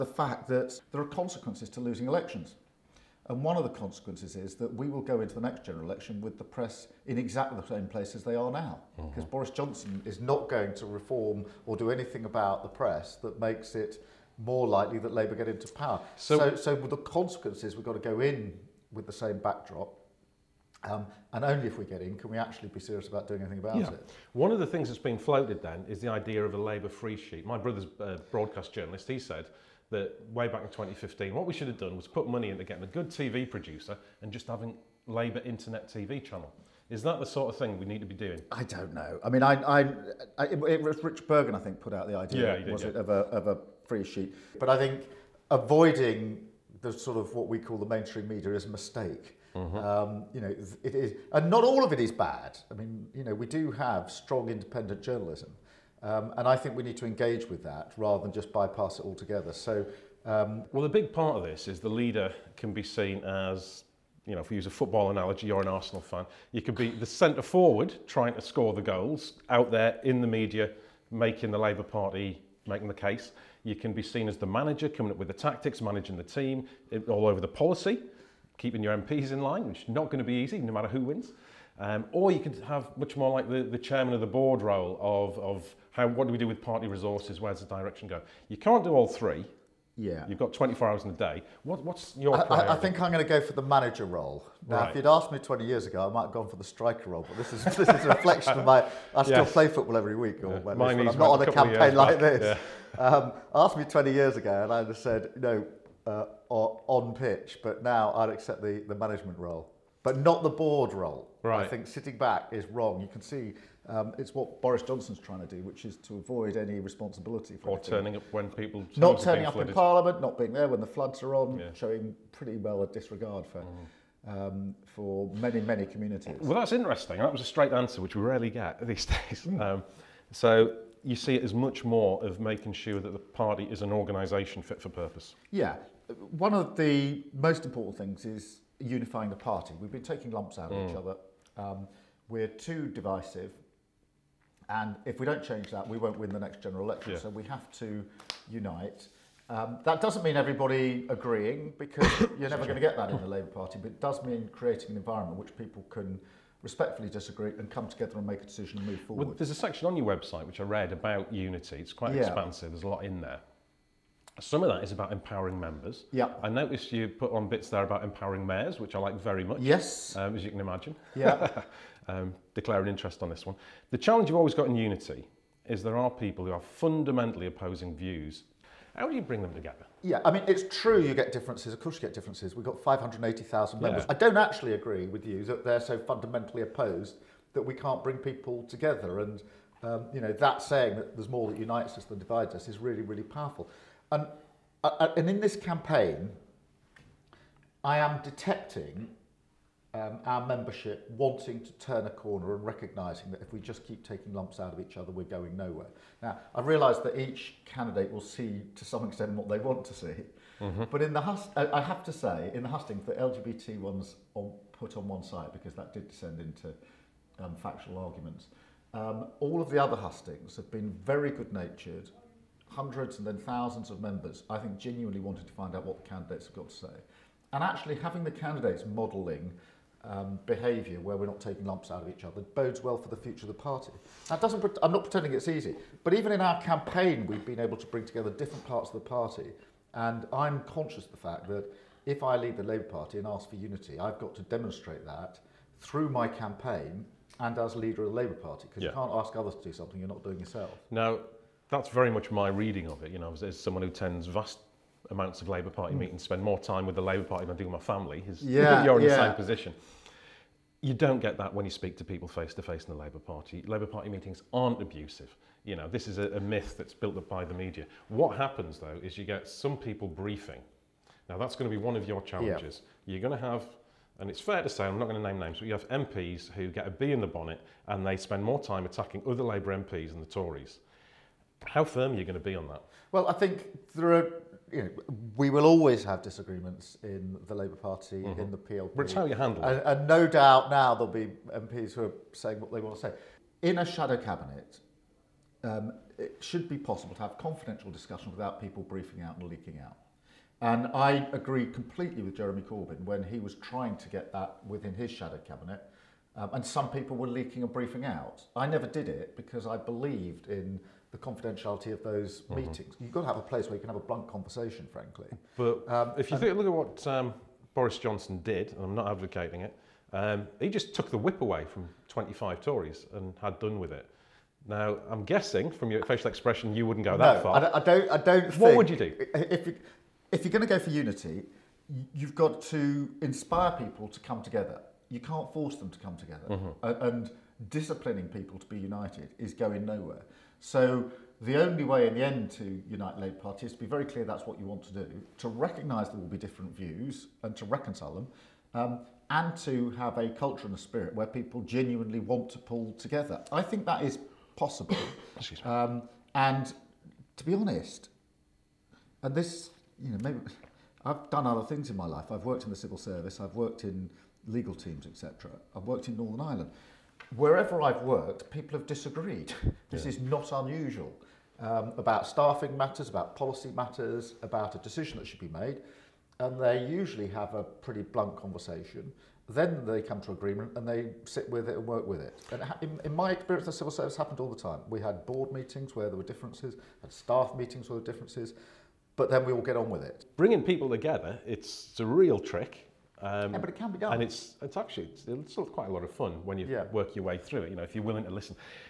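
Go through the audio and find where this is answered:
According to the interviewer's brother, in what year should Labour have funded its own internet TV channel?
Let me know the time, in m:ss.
0:30.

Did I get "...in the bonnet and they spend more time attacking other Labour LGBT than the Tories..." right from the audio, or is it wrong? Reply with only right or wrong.
wrong.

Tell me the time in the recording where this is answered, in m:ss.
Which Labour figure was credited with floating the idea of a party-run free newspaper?
0:41.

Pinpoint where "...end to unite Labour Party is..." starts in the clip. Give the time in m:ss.
5:42.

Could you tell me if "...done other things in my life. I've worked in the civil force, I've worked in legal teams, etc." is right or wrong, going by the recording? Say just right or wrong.
wrong.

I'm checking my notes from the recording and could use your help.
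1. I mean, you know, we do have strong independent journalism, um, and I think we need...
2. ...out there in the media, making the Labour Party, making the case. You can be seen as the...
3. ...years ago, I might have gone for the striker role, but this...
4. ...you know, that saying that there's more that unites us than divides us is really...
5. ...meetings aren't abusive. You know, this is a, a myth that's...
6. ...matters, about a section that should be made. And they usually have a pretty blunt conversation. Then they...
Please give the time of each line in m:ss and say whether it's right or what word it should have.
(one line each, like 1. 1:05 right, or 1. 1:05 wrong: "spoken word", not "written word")
1. 0:52 right
2. 1:09 right
3. 1:35 right
4. 3:10 right
5. 4:24 right
6. 6:13 wrong: "decision", not "section".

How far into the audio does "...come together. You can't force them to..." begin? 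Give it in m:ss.
5:34.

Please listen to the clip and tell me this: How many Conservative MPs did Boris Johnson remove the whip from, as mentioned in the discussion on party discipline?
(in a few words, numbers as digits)
25.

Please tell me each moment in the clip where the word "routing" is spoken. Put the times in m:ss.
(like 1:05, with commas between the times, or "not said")
not said.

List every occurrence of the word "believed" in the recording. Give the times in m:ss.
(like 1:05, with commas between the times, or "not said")
5:09.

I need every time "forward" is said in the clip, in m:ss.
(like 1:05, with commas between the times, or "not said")
1:07, 2:39.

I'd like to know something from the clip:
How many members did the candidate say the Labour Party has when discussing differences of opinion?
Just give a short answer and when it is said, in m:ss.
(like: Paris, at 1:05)
580,000, at 3:02.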